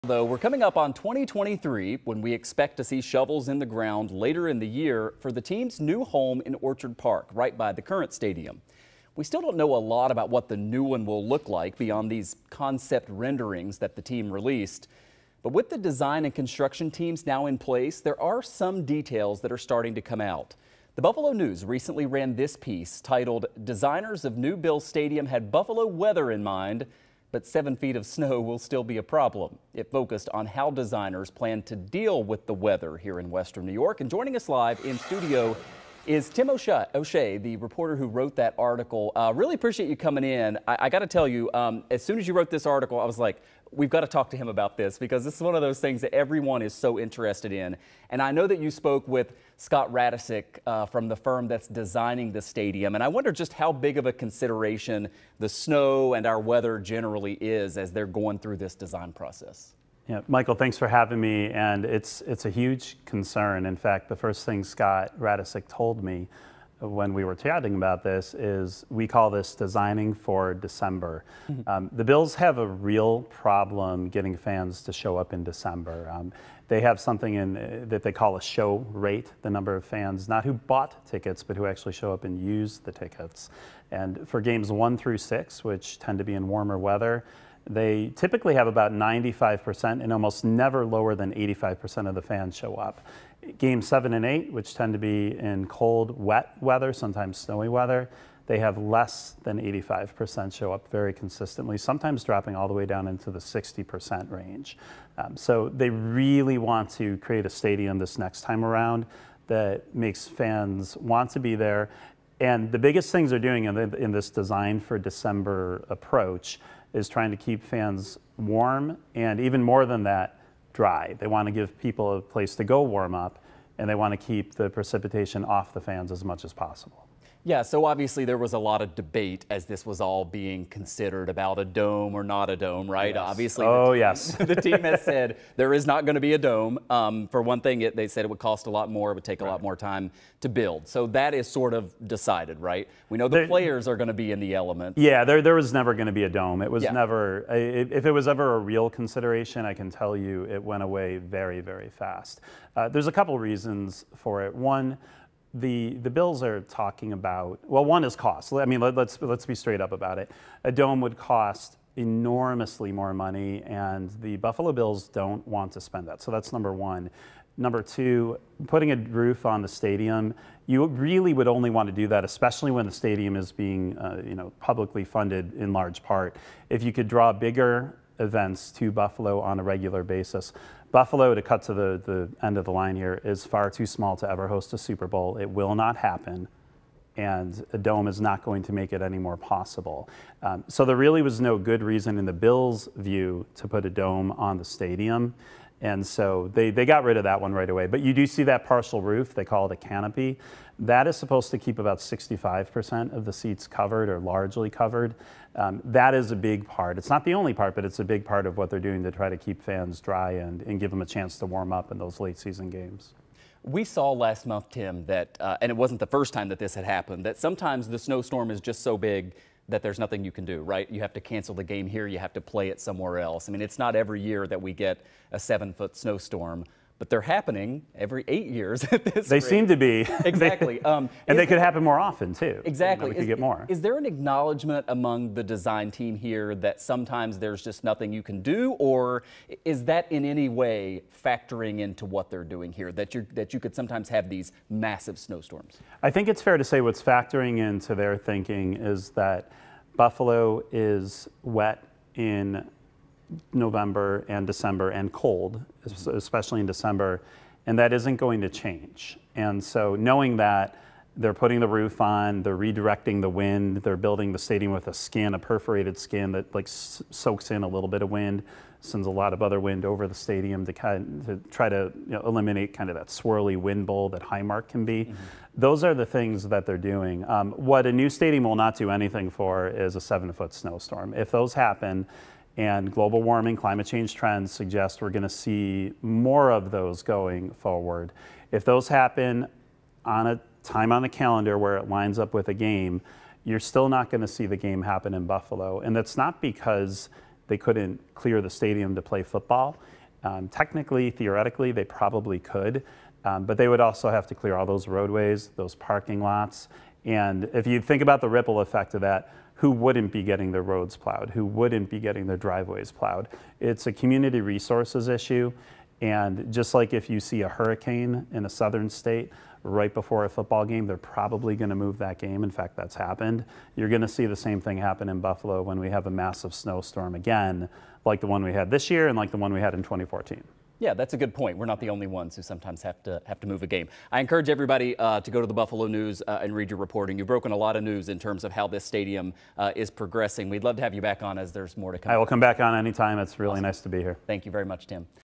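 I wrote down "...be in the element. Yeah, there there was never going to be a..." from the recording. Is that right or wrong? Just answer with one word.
right.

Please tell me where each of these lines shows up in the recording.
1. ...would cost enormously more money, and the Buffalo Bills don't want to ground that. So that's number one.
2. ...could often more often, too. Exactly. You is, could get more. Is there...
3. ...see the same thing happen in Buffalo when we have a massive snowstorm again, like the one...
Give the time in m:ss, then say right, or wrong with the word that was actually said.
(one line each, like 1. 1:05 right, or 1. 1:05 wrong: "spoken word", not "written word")
1. 2:41 wrong: "spend", not "ground"
2. 3:51 wrong: "happen", not "often"
3. 5:24 right.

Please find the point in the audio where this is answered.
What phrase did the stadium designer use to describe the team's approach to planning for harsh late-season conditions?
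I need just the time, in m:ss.
1:09.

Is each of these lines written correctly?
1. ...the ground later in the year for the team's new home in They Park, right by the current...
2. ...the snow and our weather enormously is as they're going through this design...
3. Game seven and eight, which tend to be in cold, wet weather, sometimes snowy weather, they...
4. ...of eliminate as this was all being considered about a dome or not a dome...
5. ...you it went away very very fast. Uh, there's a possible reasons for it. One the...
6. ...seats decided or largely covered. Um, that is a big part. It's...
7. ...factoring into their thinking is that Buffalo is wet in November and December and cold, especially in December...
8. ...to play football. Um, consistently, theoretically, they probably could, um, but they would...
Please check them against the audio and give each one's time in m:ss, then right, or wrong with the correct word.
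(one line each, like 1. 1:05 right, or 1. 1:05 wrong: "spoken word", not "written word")
1. 0:03 wrong: "Orchard", not "They"
2. 0:55 wrong: "generally", not "enormously"
3. 1:33 right
4. 2:08 wrong: "debate", not "eliminate"
5. 2:30 wrong: "couple", not "possible"
6. 3:23 wrong: "covered", not "decided"
7. 4:07 right
8. 4:58 wrong: "technically", not "consistently".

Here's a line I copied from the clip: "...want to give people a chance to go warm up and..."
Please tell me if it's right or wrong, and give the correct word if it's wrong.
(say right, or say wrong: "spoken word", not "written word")
wrong: "place", not "chance".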